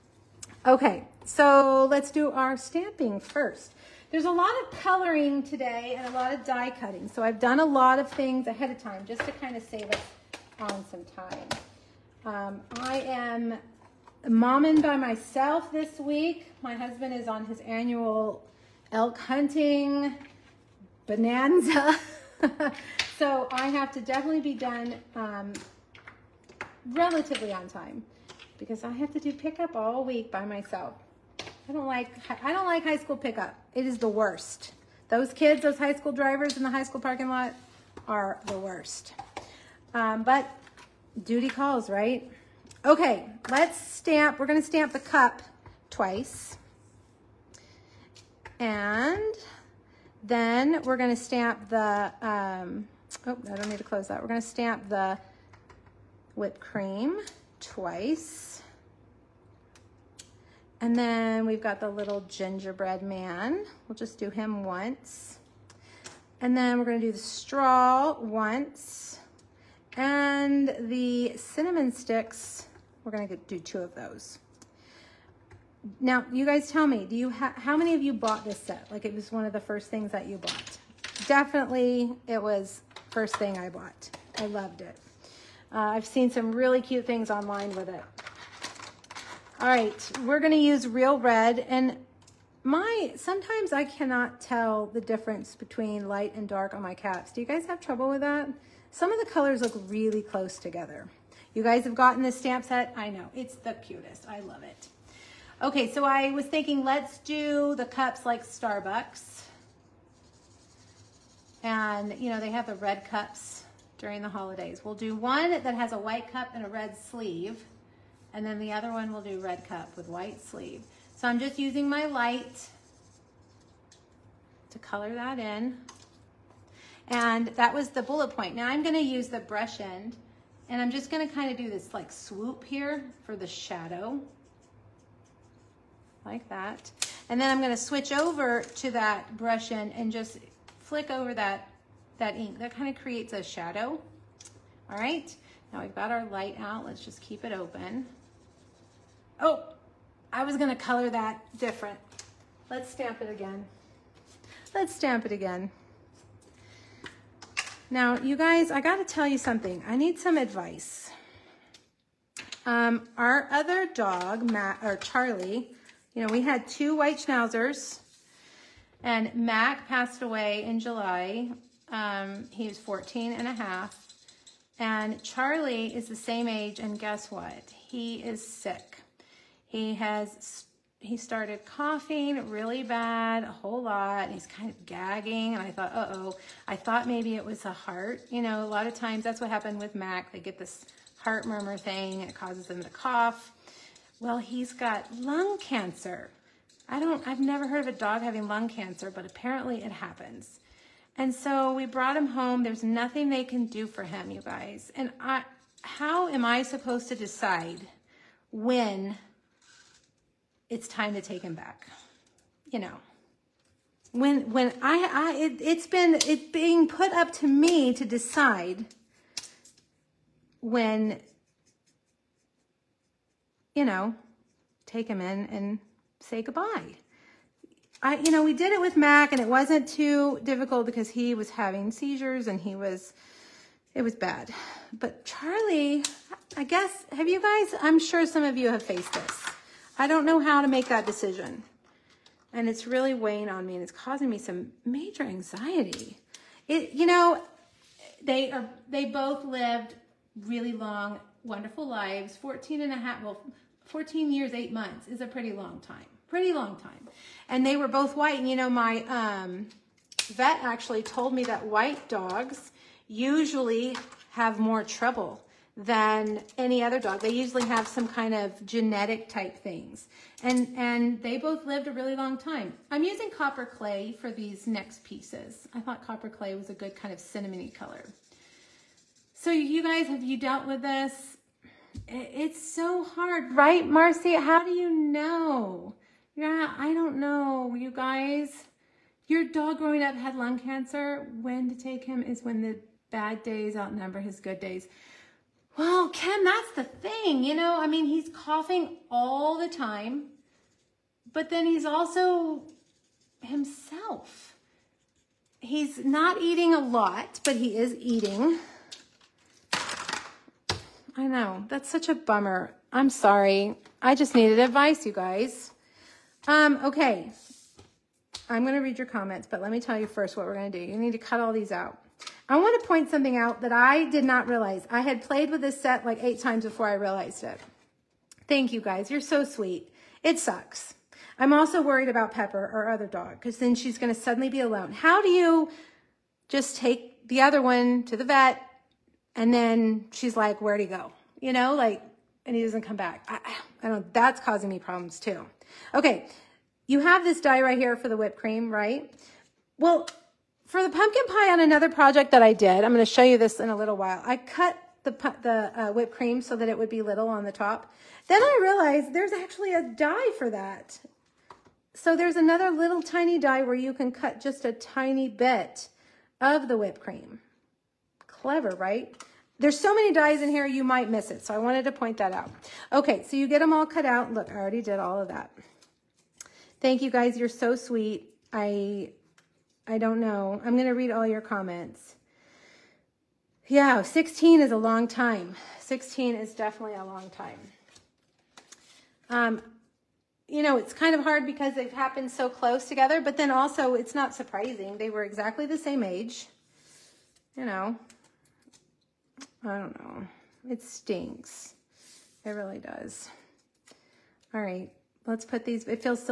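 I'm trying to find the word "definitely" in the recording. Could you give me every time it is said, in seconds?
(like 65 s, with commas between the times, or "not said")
23 s, 81 s, 386 s.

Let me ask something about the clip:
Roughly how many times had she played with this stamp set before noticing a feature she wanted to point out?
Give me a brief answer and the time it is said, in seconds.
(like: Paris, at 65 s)
8 times, at 326 s.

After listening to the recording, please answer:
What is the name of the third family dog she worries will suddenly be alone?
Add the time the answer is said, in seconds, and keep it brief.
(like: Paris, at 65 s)
Pepper, at 332 s.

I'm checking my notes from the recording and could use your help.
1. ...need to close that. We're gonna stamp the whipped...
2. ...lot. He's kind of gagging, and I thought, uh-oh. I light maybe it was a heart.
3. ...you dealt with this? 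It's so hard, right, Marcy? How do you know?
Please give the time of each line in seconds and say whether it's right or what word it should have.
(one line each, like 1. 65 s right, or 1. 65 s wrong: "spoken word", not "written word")
1. 53 s right
2. 183 s wrong: "thought", not "light"
3. 280 s right.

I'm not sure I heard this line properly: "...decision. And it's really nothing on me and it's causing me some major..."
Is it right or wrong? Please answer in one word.
wrong.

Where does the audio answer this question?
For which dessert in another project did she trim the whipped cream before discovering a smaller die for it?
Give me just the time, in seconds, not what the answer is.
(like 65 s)
350 s.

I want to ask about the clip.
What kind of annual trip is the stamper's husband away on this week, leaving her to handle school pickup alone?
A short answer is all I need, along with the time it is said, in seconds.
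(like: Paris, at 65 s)
Elk hunting, at 18 s.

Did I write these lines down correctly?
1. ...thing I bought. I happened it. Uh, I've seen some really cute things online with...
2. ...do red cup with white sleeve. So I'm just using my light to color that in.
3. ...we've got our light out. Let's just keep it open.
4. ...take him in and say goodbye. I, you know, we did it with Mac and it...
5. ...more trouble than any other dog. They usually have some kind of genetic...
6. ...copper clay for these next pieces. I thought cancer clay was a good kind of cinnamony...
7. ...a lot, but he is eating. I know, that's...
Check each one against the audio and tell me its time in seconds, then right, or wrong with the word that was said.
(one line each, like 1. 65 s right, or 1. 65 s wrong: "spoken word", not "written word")
1. 83 s wrong: "loved", not "happened"
2. 119 s right
3. 145 s right
4. 224 s right
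5. 264 s right
6. 273 s wrong: "copper", not "cancer"
7. 306 s right.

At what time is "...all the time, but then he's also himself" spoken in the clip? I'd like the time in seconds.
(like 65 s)
299 s.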